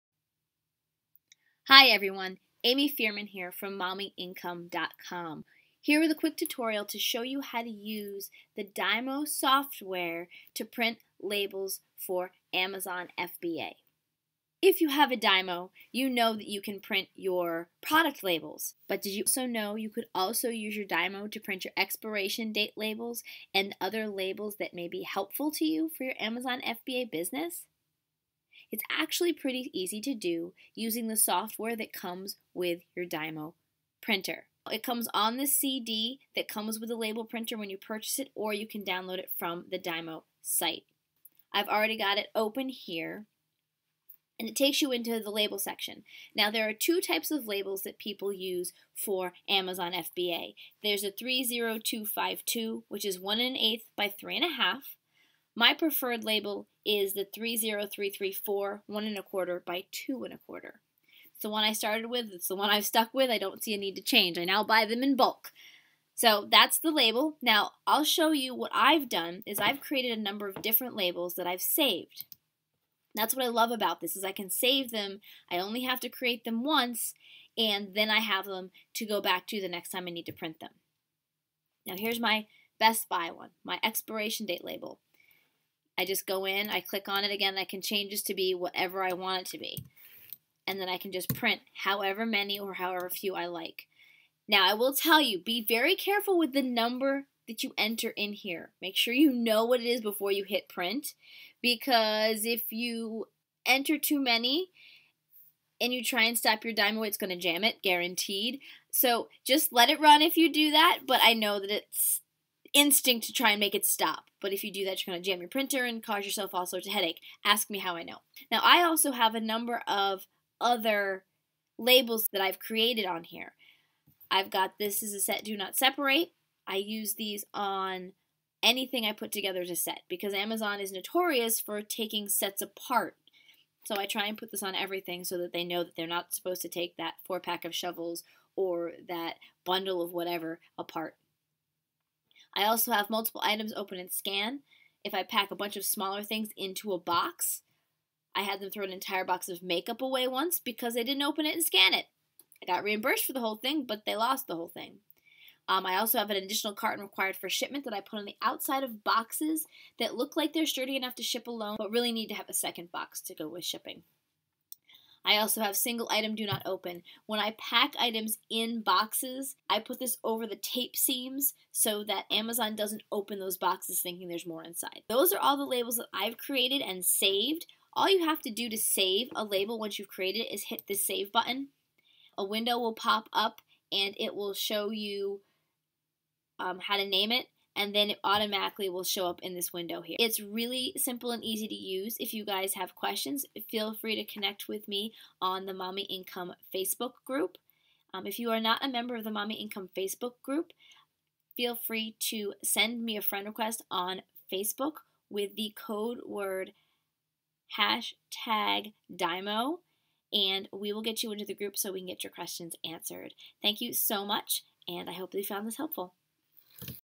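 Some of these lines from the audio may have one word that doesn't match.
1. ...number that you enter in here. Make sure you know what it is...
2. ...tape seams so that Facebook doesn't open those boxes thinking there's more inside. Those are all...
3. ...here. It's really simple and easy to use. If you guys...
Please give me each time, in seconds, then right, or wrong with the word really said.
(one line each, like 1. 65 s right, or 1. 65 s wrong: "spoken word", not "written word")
1. 96 s right
2. 170 s wrong: "Amazon", not "Facebook"
3. 190 s right.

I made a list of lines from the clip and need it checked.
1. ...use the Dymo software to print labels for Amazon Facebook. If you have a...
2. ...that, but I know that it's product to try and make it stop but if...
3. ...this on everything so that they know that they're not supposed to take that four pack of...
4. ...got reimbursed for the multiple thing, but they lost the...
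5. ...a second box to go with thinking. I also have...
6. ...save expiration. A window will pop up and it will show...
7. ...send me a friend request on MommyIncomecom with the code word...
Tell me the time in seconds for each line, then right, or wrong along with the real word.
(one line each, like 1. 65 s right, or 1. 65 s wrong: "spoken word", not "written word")
1. 7 s wrong: "FBA", not "Facebook"
2. 110 s wrong: "instinct", not "product"
3. 134 s right
4. 152 s wrong: "whole", not "multiple"
5. 162 s wrong: "shipping", not "thinking"
6. 180 s wrong: "button", not "expiration"
7. 202 s wrong: "Facebook", not "MommyIncomecom".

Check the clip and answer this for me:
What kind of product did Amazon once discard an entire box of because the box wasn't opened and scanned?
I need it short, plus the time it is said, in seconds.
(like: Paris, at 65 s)
makeup, at 149 s.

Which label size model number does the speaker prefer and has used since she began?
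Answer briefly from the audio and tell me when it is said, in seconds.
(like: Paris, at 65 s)
30334, at 57 s.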